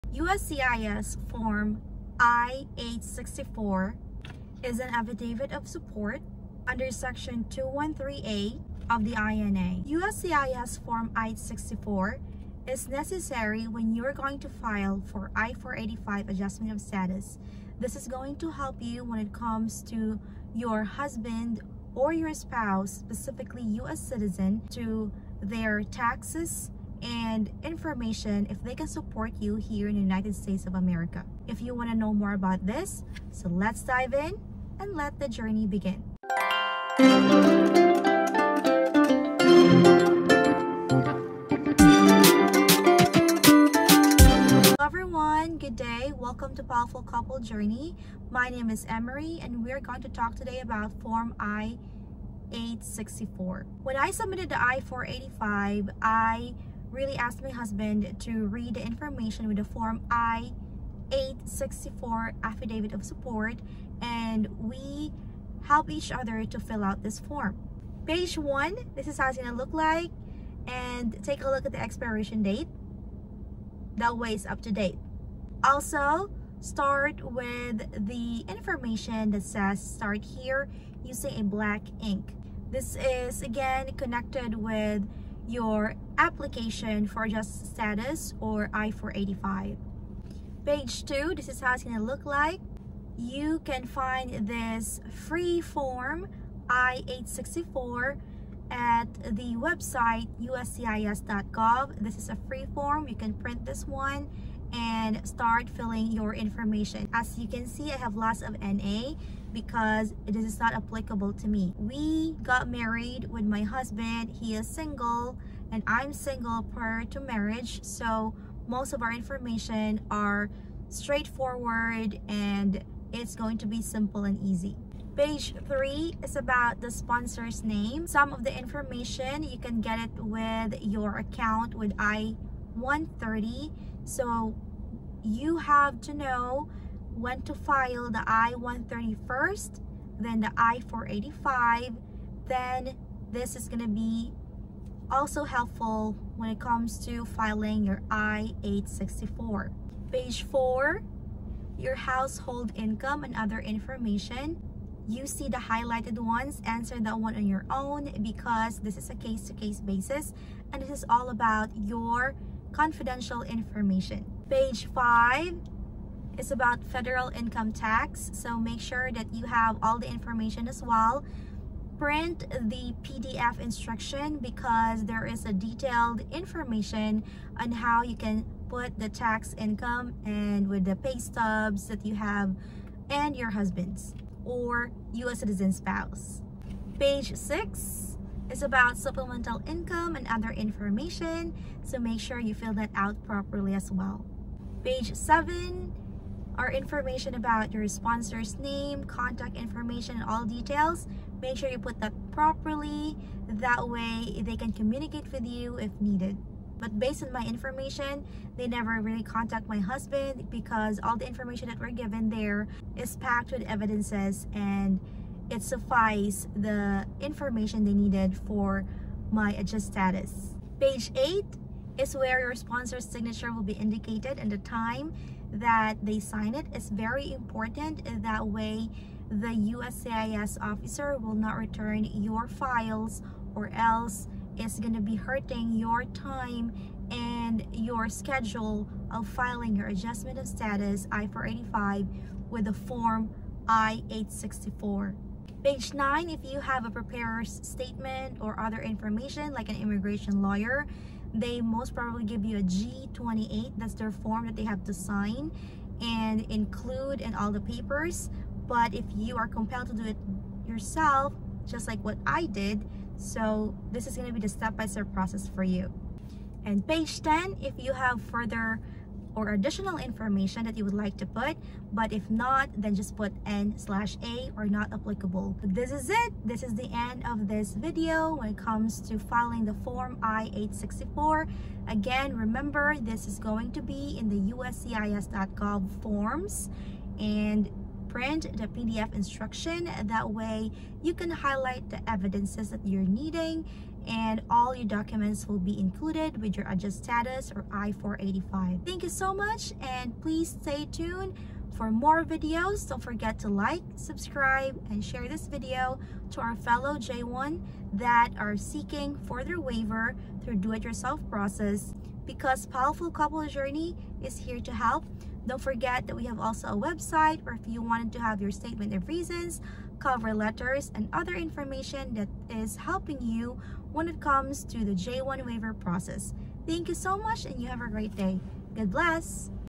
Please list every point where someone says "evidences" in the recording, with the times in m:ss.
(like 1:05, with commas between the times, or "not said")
3:33, 4:52.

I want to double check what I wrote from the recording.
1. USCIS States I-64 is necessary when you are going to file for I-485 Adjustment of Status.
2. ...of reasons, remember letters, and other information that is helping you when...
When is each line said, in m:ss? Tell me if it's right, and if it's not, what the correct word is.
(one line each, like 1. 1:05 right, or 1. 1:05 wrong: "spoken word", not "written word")
1. 0:09 wrong: "Form", not "States"
2. 5:18 wrong: "cover", not "remember".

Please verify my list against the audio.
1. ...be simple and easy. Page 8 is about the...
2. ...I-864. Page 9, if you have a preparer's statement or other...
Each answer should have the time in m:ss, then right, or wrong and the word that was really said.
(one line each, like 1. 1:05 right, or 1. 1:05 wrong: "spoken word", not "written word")
1. 2:03 wrong: "3", not "8"
2. 4:03 right.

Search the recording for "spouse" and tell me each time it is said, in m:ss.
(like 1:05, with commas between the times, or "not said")
0:22, 3:05.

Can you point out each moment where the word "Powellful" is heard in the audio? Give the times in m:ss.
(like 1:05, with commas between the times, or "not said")
0:46, 5:12.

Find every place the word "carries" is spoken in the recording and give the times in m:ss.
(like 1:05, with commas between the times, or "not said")
not said.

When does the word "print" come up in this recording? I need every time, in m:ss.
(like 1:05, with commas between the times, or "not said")
1:43, 2:51, 4:48.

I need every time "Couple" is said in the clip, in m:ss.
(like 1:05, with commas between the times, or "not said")
0:47, 5:13.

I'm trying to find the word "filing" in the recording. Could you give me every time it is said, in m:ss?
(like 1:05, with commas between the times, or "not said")
2:27, 3:59, 4:39.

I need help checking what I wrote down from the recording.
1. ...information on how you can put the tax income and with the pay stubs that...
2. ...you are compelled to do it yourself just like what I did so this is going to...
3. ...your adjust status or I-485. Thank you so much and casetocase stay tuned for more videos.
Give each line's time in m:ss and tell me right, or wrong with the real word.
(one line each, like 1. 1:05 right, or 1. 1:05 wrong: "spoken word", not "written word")
1. 2:56 right
2. 4:19 right
3. 4:56 wrong: "please", not "casetocase".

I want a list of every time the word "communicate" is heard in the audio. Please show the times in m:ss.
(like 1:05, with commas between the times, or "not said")
3:24.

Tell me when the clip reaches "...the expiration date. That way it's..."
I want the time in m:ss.
1:11.